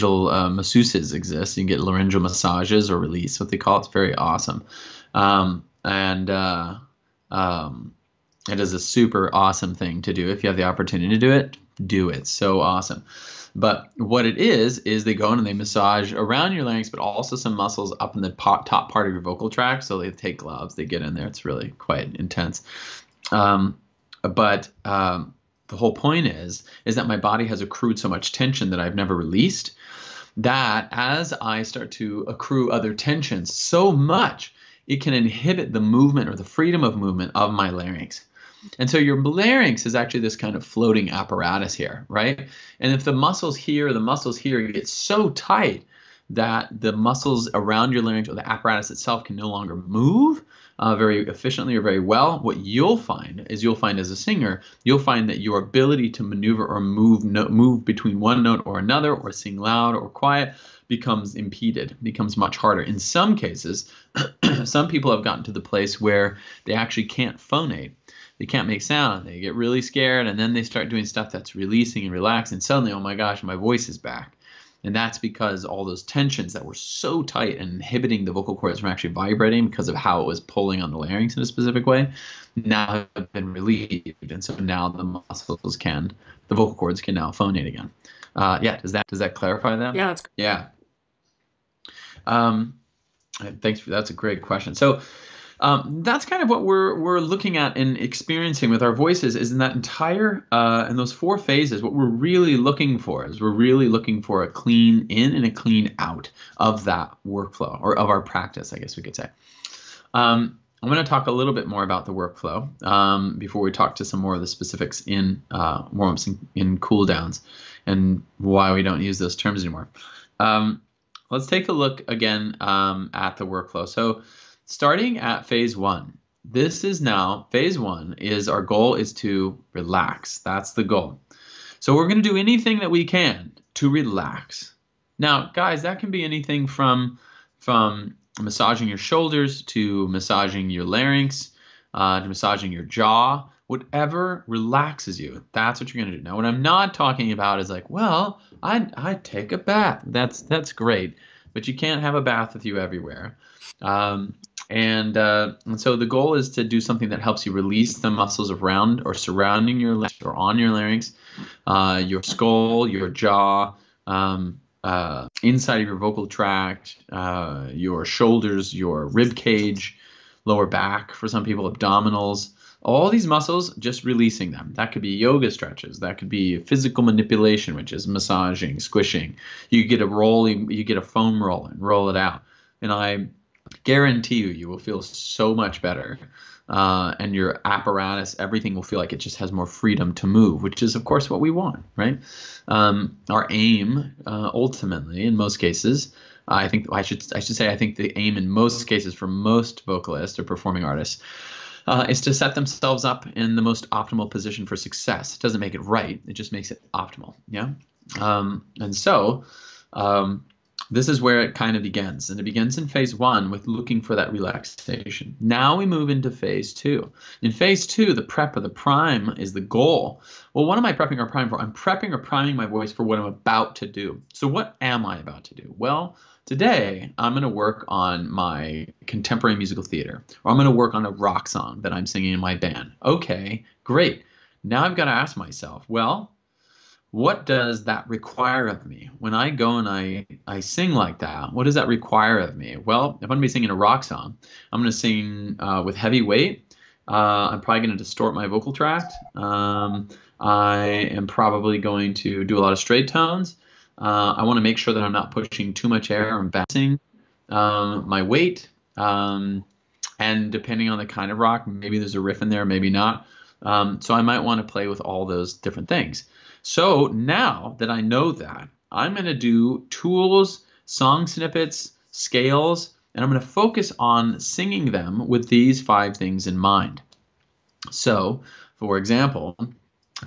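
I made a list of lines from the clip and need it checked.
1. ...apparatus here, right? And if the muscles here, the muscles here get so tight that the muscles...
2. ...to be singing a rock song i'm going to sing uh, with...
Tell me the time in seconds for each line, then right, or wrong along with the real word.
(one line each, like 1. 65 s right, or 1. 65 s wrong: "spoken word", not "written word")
1. 41 s right
2. 243 s right.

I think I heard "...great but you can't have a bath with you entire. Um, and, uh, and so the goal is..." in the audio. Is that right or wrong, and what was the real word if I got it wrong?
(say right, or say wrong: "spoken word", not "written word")
wrong: "everywhere", not "entire".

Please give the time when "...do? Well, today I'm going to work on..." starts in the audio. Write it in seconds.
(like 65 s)
225 s.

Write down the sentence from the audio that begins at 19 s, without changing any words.
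So they take gloves, they get in there.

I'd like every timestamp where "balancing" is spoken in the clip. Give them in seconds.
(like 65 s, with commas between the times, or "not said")
256 s.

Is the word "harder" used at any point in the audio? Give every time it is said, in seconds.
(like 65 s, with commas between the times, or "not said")
62 s.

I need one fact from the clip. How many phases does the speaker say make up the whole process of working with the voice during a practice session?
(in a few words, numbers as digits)
4.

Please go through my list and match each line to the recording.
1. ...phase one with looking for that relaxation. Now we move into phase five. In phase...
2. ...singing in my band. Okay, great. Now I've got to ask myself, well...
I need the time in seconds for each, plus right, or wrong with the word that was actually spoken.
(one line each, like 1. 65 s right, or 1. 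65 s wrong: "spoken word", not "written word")
1. 212 s wrong: "two", not "five"
2. 232 s right.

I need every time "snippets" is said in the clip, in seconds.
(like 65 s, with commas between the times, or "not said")
271 s.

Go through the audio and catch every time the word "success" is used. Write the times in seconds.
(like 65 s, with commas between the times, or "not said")
204 s.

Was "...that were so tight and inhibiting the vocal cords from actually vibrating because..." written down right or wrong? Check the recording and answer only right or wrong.
right.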